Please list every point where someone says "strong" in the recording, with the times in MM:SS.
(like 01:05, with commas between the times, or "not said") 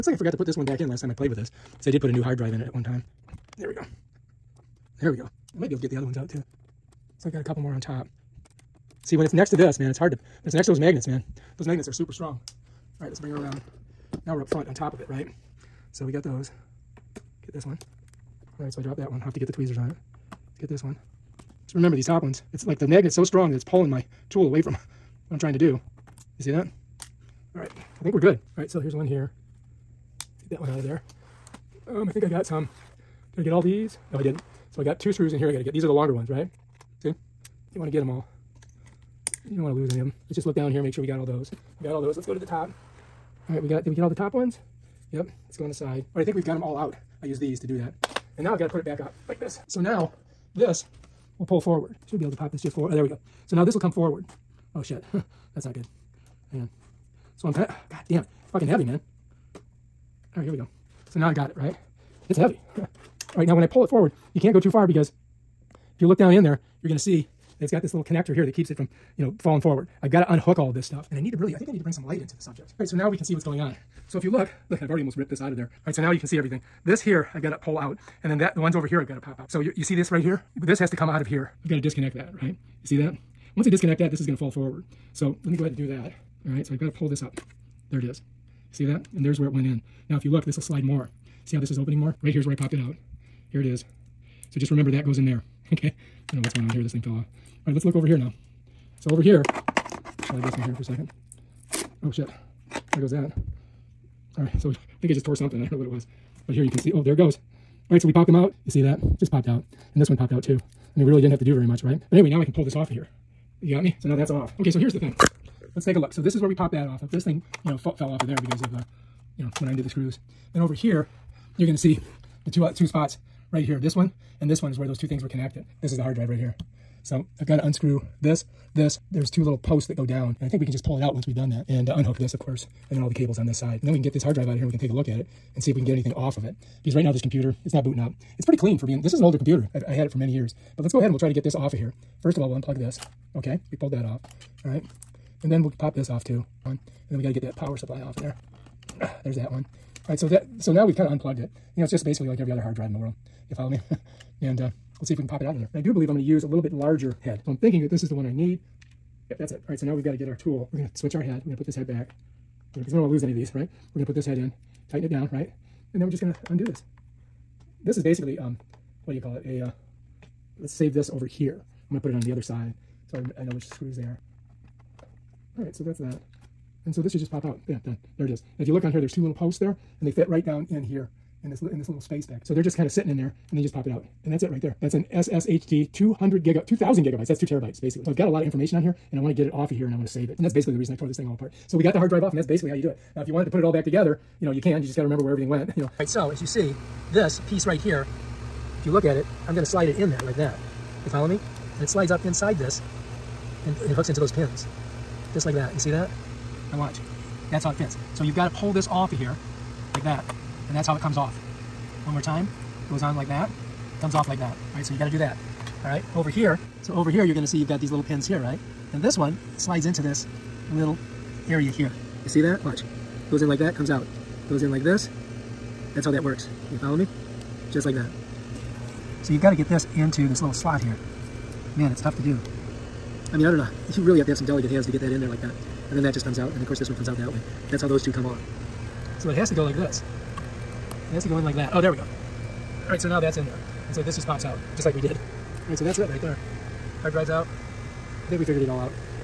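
00:12, 00:23.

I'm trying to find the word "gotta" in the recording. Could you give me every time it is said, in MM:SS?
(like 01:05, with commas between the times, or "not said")
02:27, 03:34.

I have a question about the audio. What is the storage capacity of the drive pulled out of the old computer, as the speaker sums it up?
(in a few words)
2 terabytes.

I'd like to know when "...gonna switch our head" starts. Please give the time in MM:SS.
02:40.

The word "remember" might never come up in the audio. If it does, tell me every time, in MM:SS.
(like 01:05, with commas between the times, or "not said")
00:21, 01:34, 03:15.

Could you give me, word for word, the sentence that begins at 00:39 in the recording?
You don't want to lose any of them.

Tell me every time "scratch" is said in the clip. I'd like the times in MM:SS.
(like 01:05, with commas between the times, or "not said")
not said.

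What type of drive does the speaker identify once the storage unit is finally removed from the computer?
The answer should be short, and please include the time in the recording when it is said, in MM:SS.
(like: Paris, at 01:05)
SSHD, at 03:05.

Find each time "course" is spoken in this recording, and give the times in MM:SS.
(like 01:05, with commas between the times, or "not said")
02:12, 03:56.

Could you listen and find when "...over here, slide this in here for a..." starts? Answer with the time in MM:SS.
01:39.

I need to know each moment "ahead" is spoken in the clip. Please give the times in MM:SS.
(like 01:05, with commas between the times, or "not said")
01:25, 02:20.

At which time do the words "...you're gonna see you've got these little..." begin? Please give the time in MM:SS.
03:37.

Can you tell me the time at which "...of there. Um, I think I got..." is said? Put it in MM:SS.
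00:30.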